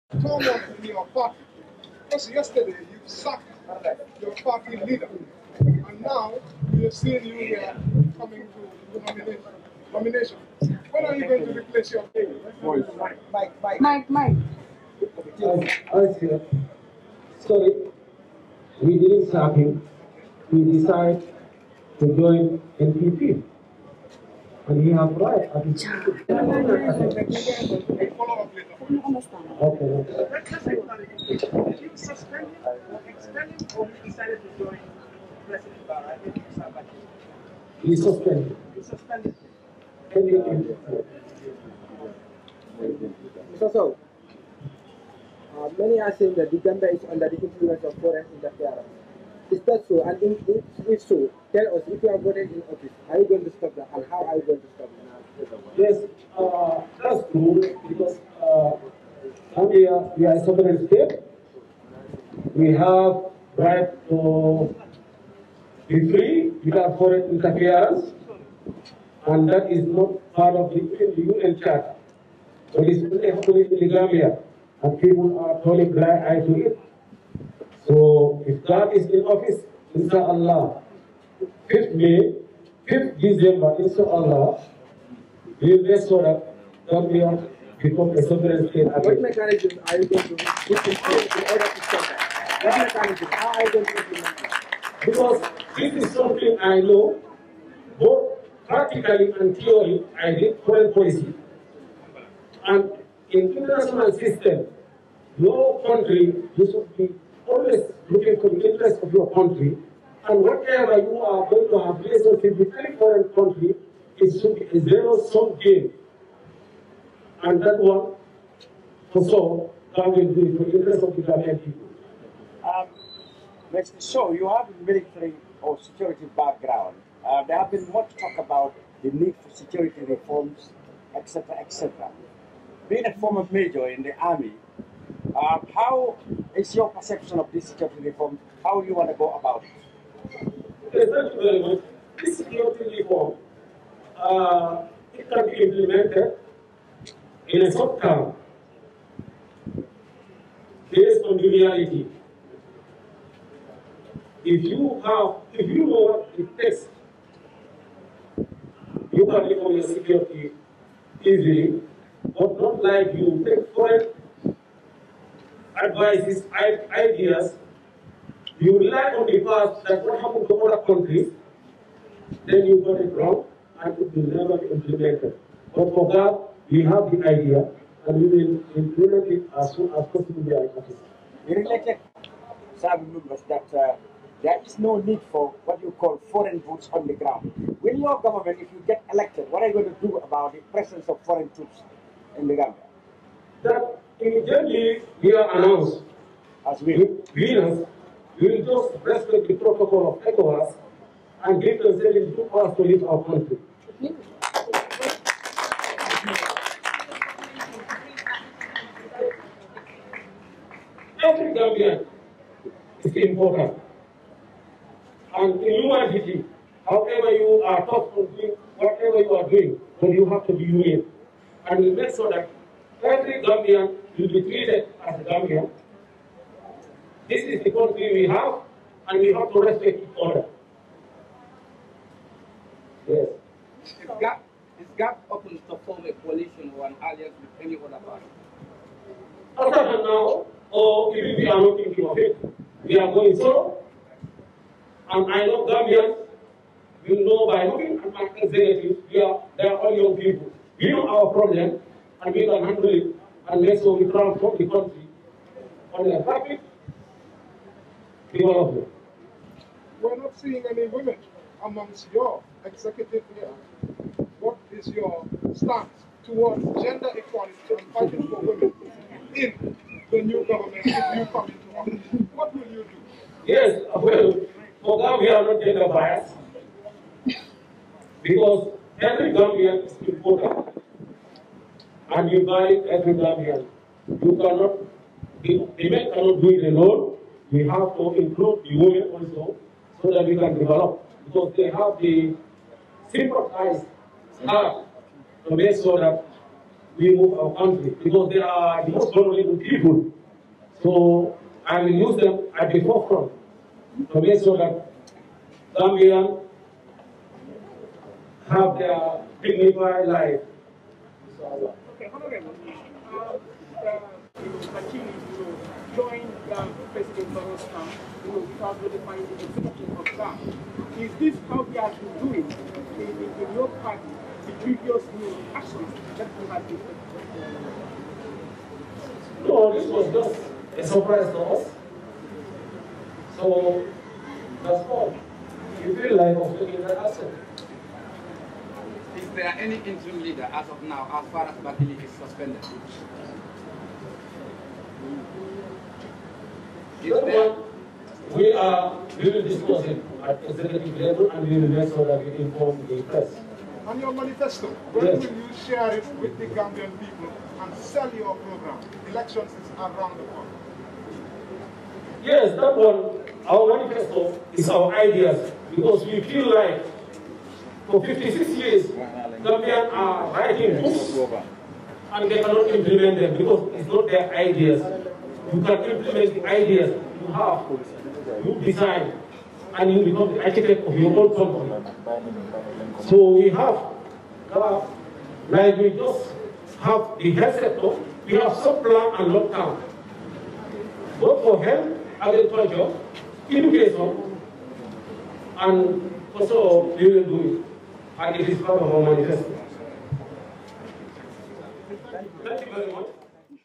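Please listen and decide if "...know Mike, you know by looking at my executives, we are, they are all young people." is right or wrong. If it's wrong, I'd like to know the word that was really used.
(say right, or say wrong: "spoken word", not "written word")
wrong: "Gambians", not "Mike".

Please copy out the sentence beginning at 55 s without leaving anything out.
Yes, uh, that's true because uh, we, are, a sovereign state.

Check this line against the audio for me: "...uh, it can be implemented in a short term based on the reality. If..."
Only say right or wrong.
right.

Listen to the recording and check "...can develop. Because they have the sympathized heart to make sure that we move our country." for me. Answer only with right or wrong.
right.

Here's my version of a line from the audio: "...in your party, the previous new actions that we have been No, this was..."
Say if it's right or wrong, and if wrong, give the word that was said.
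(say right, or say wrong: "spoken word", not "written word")
right.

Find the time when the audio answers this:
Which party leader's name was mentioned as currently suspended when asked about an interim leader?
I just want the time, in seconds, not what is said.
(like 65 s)
341 s.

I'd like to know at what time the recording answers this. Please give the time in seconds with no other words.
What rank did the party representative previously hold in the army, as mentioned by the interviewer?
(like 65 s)
133 s.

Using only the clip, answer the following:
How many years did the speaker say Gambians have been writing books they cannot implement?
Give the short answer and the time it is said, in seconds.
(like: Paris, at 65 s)
56, at 368 s.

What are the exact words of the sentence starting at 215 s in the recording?
And in humanity, however you are taught to do whatever you are doing, then you have to be union.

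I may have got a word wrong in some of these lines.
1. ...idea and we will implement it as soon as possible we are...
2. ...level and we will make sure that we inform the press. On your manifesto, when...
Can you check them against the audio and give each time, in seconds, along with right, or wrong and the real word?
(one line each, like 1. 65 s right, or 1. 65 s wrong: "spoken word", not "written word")
1. 177 s right
2. 350 s right.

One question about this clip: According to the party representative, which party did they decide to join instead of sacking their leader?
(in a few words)
NPP.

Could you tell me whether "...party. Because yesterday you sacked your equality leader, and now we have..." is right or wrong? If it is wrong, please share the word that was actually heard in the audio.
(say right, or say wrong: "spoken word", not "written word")
wrong: "party", not "equality".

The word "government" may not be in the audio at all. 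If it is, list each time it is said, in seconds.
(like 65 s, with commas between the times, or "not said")
188 s, 270 s.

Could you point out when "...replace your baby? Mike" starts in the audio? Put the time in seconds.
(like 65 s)
11 s.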